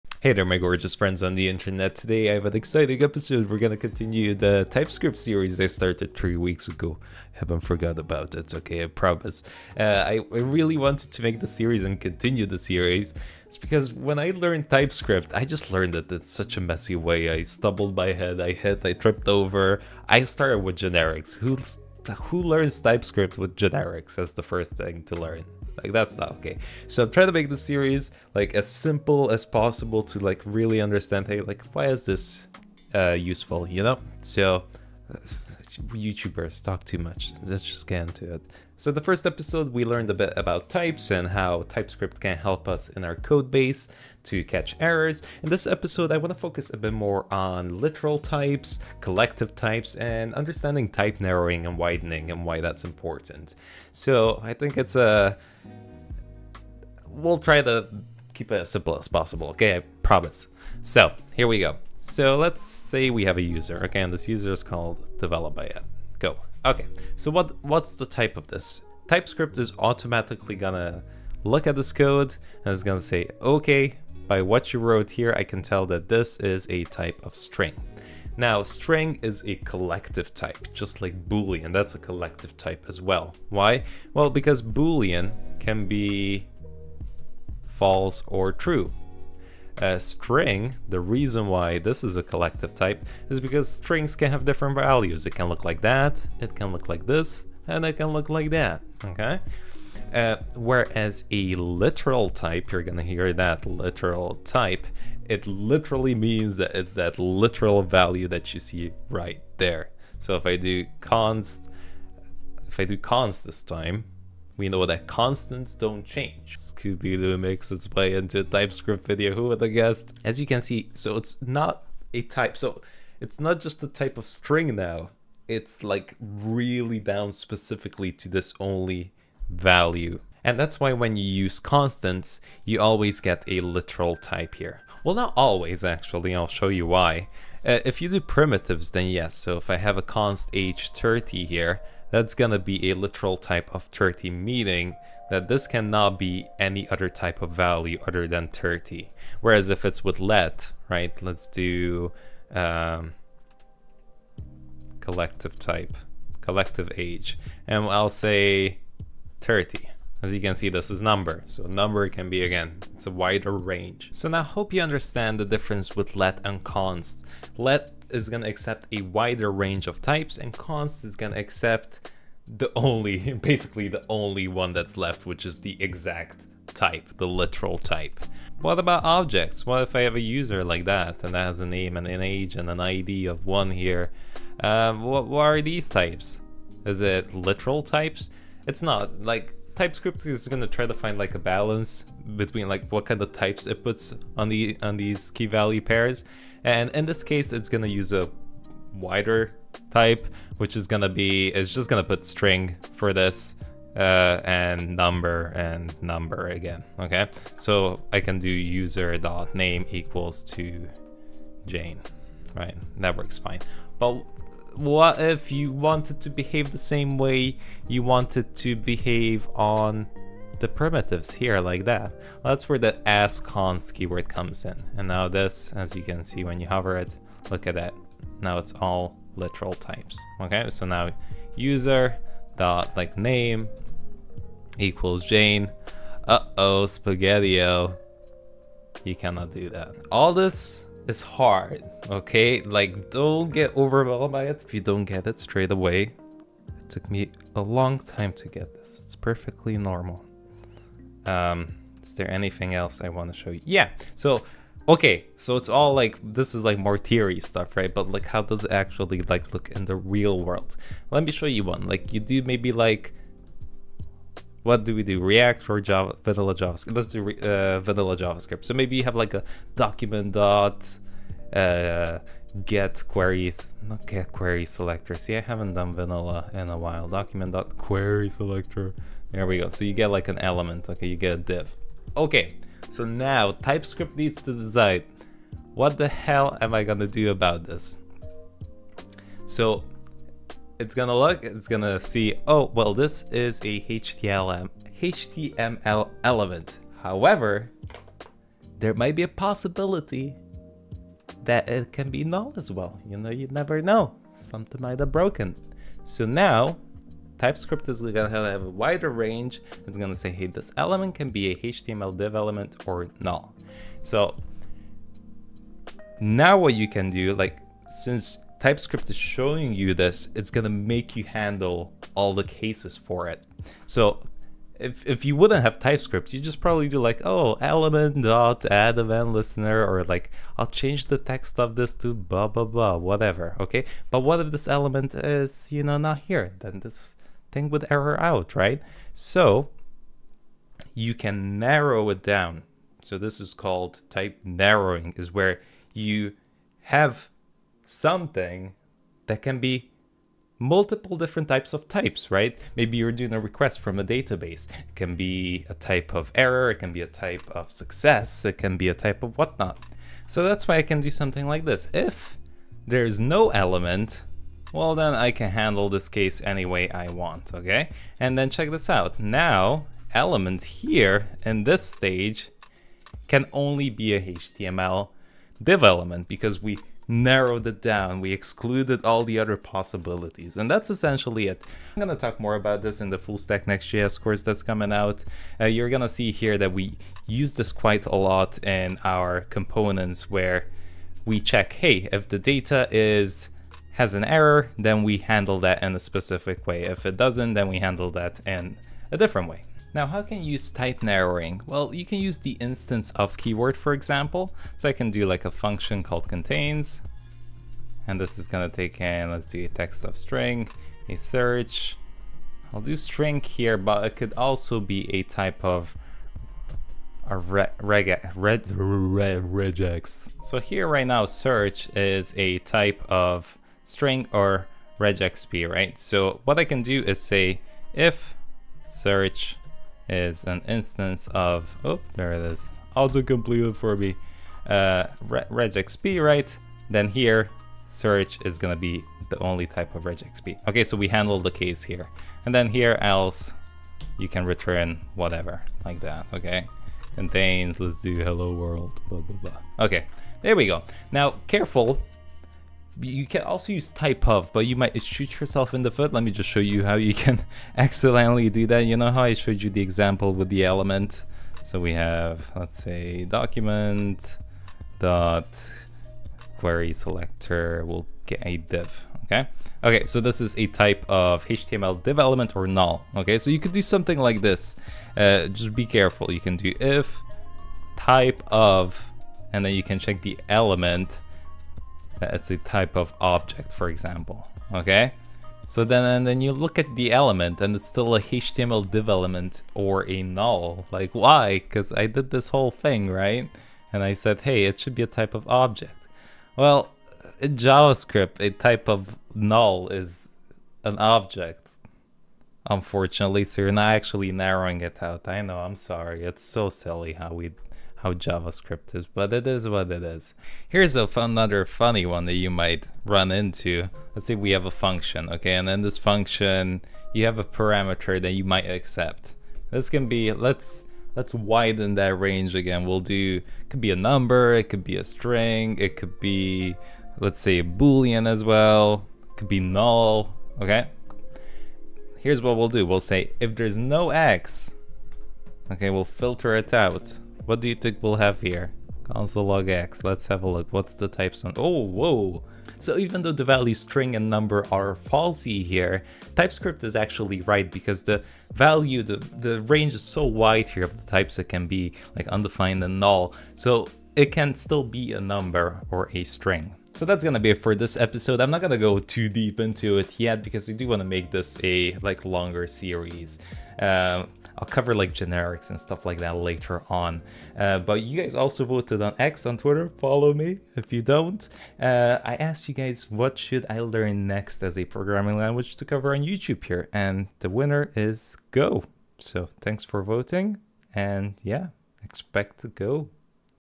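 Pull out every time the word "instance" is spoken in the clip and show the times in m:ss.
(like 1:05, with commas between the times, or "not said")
6:42, 7:10.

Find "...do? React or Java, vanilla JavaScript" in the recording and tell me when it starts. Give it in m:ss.
4:25.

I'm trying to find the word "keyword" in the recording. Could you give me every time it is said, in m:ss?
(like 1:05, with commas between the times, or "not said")
3:43, 6:43.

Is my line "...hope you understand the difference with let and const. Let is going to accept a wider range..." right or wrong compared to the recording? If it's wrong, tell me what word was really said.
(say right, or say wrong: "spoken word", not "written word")
right.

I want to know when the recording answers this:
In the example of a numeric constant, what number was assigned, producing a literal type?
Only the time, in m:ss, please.
2:20.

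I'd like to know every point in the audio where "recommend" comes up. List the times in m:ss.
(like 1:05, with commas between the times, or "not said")
not said.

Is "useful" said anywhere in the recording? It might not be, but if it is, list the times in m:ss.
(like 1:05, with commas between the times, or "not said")
0:33.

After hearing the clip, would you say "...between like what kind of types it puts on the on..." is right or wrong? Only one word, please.
right.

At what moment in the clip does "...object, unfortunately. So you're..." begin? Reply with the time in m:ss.
8:20.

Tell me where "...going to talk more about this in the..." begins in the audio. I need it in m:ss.
6:22.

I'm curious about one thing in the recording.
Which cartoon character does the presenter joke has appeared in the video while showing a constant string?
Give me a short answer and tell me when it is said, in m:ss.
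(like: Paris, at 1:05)
Scooby-Doo, at 1:56.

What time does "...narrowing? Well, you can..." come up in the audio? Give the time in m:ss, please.
6:41.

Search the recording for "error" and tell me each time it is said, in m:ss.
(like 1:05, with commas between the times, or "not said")
0:44, 5:37, 5:56, 6:34.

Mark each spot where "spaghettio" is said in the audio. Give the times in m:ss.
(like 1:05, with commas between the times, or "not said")
3:56.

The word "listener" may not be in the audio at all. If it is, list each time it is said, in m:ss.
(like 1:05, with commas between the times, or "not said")
5:29.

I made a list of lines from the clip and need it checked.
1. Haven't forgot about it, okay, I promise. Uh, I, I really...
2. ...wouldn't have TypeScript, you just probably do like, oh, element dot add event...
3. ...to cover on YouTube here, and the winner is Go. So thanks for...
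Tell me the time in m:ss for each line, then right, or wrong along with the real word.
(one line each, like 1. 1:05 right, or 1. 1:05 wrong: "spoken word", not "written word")
1. 0:07 right
2. 5:25 right
3. 9:35 right.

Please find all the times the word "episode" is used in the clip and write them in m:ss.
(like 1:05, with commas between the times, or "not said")
0:03, 0:39, 0:45, 9:17.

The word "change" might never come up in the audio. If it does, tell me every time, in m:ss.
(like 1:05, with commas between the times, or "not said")
1:56, 5:30.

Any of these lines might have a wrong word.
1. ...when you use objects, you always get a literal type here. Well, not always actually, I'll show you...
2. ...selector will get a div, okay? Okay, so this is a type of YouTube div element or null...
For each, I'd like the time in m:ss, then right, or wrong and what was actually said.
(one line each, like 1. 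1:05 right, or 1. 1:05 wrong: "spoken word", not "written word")
1. 2:10 wrong: "constants", not "objects"
2. 7:46 wrong: "HTML", not "YouTube".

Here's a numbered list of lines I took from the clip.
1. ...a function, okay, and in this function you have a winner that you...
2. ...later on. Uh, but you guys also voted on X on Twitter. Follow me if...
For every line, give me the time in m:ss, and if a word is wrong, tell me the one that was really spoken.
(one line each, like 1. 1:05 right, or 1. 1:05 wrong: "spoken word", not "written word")
1. 8:34 wrong: "parameter", not "winner"
2. 9:26 right.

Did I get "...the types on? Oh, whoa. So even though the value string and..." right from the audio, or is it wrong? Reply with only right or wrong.
right.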